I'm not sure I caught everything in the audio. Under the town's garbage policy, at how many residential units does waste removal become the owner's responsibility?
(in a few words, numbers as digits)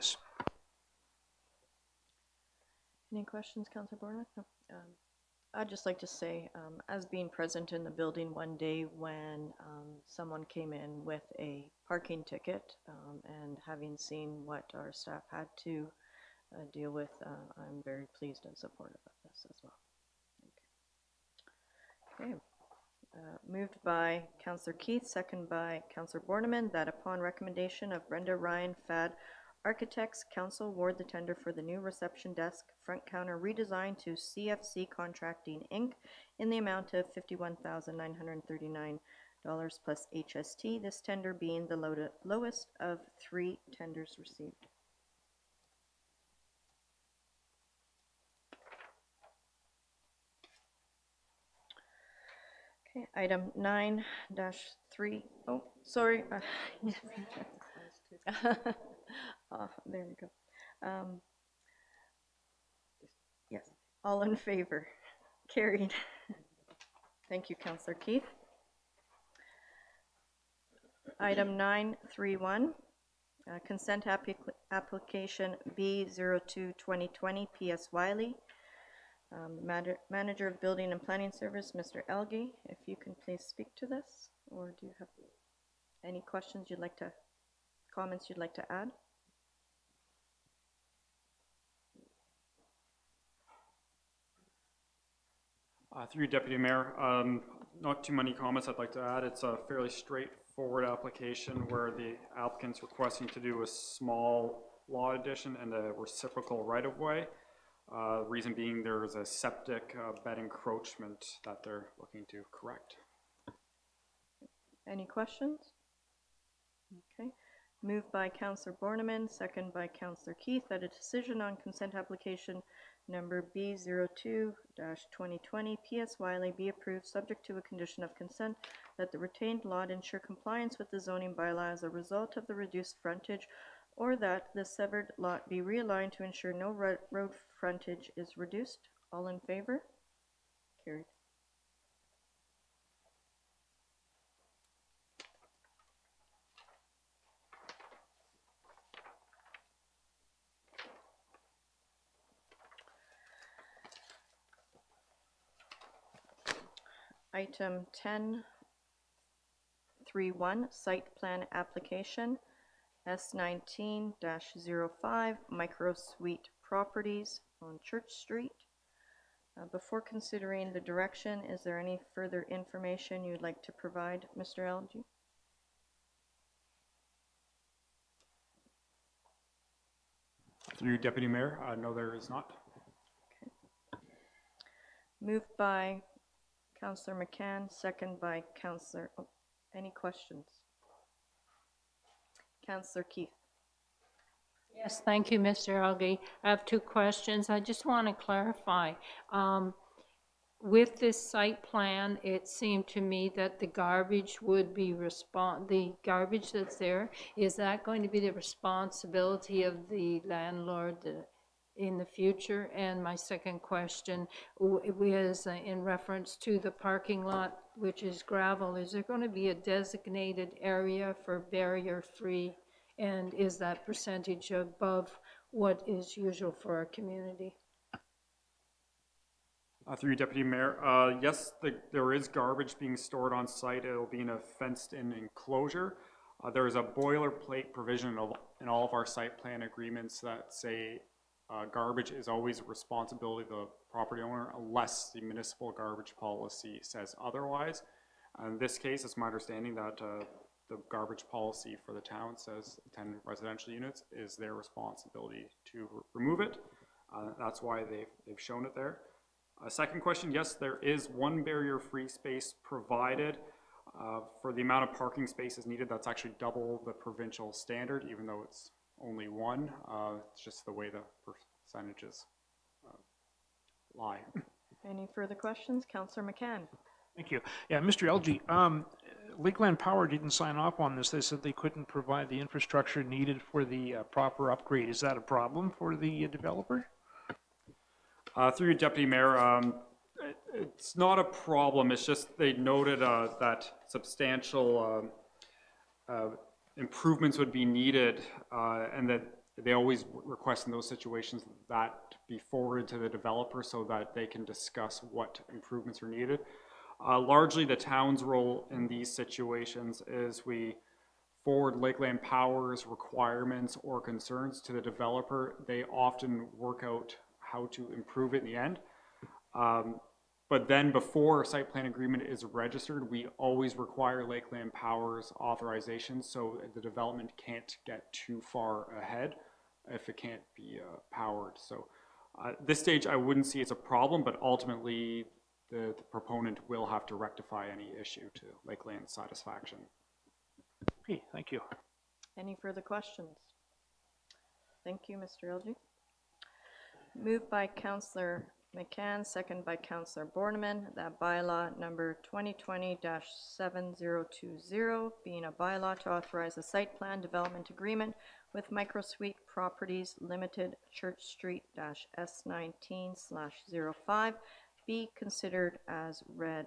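10.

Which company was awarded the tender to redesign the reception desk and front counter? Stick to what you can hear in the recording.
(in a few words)
CFC Contracting Inc.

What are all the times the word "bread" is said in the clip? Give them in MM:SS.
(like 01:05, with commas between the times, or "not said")
not said.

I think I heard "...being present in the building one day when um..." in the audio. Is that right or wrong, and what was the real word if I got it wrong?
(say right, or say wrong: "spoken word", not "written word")
right.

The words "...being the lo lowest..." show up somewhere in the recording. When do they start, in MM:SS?
00:41.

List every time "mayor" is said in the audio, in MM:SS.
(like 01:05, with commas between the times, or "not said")
01:36, 03:01, 03:50, 04:49.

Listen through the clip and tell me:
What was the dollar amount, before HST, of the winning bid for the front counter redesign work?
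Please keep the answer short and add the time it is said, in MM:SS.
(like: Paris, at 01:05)
$51,939, at 00:37.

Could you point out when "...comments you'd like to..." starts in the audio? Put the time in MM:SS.
01:27.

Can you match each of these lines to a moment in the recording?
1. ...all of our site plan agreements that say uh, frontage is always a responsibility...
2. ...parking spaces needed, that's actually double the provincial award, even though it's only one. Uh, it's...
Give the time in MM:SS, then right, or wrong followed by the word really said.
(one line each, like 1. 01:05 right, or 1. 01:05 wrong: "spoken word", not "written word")
1. 03:58 wrong: "garbage", not "frontage"
2. 04:24 wrong: "standard", not "award".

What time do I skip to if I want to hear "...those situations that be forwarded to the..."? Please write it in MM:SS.
05:00.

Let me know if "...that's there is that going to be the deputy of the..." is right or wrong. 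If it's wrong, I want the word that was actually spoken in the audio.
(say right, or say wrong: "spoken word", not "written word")
wrong: "responsibility", not "deputy".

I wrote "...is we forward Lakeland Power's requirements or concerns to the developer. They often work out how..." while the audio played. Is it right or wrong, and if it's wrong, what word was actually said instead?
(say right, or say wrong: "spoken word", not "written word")
right.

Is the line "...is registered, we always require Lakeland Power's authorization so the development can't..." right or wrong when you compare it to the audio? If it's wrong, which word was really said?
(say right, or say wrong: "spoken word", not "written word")
right.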